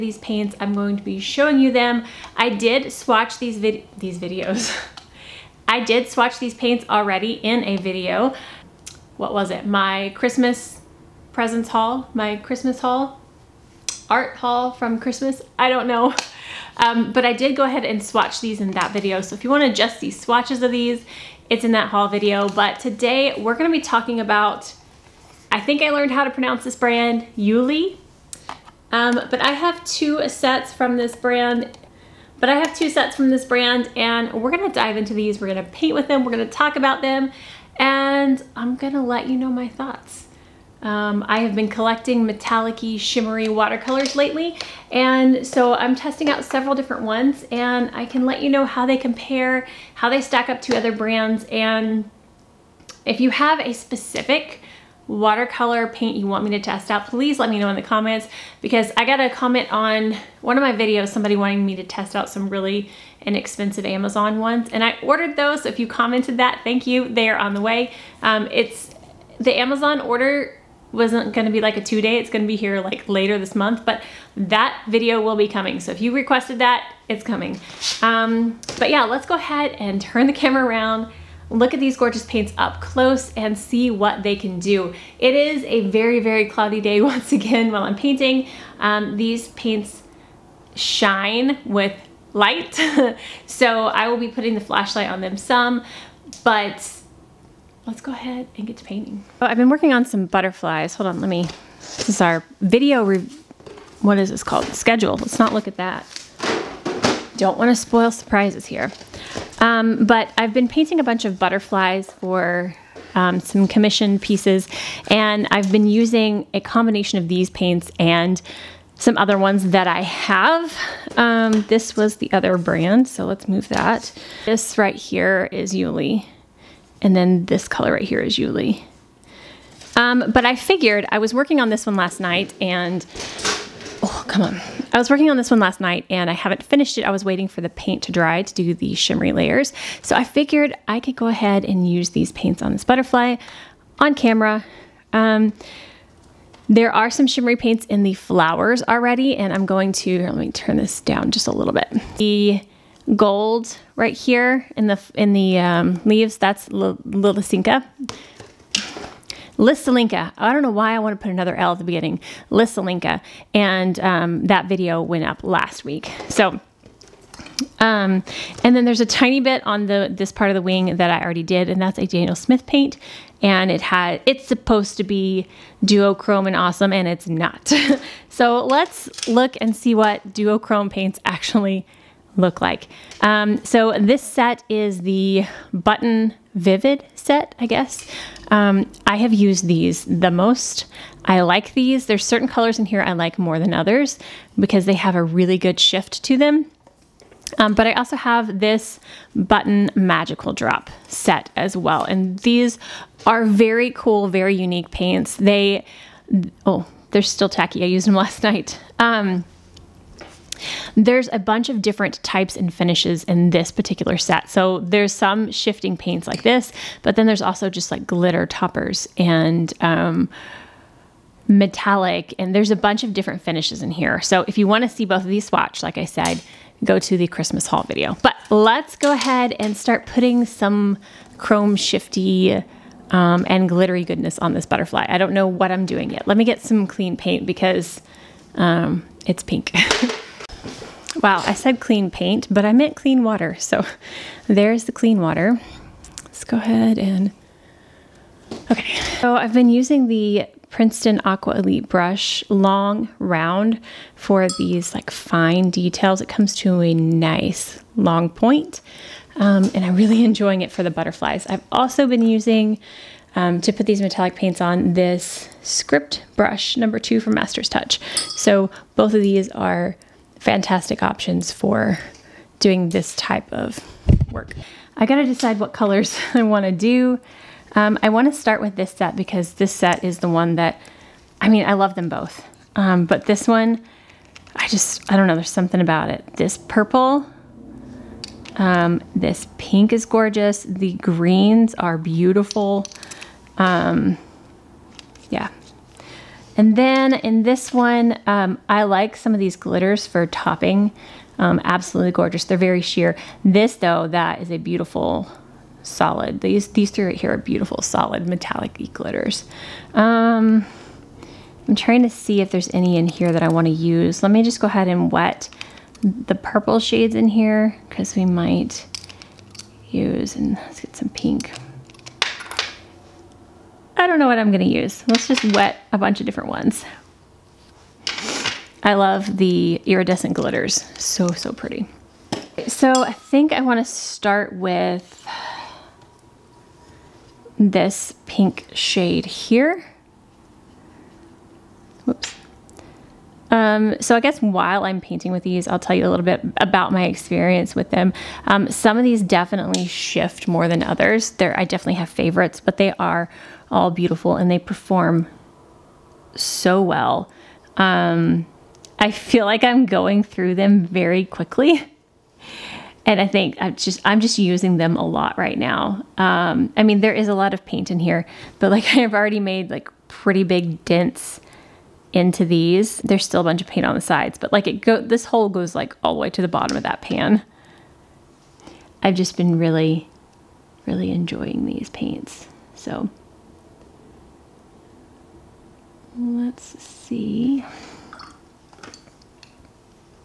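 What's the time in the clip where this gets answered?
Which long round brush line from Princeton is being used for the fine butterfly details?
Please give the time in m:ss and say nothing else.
4:11.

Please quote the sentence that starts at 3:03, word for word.
Um, so this set is the Button Vivid set, I guess.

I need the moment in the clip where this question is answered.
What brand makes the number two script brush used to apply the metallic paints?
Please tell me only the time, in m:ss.
4:27.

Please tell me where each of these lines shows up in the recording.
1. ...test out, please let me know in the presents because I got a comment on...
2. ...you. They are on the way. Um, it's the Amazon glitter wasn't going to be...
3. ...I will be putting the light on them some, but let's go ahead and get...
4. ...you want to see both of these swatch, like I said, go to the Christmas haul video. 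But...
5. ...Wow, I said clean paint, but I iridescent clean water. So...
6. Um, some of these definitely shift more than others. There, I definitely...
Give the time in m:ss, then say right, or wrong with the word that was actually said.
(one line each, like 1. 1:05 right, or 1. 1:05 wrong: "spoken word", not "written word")
1. 0:56 wrong: "comments", not "presents"
2. 1:06 wrong: "order", not "glitter"
3. 1:33 wrong: "flashlight", not "light"
4. 3:44 right
5. 4:01 wrong: "meant", not "iridescent"
6. 5:48 right.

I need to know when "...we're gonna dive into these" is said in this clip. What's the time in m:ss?
0:34.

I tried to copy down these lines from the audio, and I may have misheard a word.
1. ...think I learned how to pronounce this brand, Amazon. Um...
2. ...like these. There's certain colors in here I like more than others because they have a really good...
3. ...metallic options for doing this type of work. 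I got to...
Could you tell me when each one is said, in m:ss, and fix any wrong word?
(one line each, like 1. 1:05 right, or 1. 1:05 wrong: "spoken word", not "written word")
1. 0:25 wrong: "IUILE", not "Amazon"
2. 3:11 right
3. 4:30 wrong: "fantastic", not "metallic".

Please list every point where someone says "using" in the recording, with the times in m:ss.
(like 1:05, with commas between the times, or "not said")
1:55, 4:09, 4:22, 6:04.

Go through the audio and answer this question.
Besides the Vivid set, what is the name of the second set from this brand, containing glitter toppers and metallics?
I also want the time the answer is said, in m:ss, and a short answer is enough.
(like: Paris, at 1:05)
Magical Drop, at 3:19.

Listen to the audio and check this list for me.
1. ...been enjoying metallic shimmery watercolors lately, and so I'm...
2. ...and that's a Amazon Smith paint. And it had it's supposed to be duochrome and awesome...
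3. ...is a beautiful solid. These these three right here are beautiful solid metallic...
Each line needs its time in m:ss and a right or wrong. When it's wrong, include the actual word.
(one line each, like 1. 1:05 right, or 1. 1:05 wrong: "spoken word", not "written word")
1. 0:41 wrong: "collecting", not "enjoying"
2. 2:51 wrong: "Daniel", not "Amazon"
3. 5:04 right.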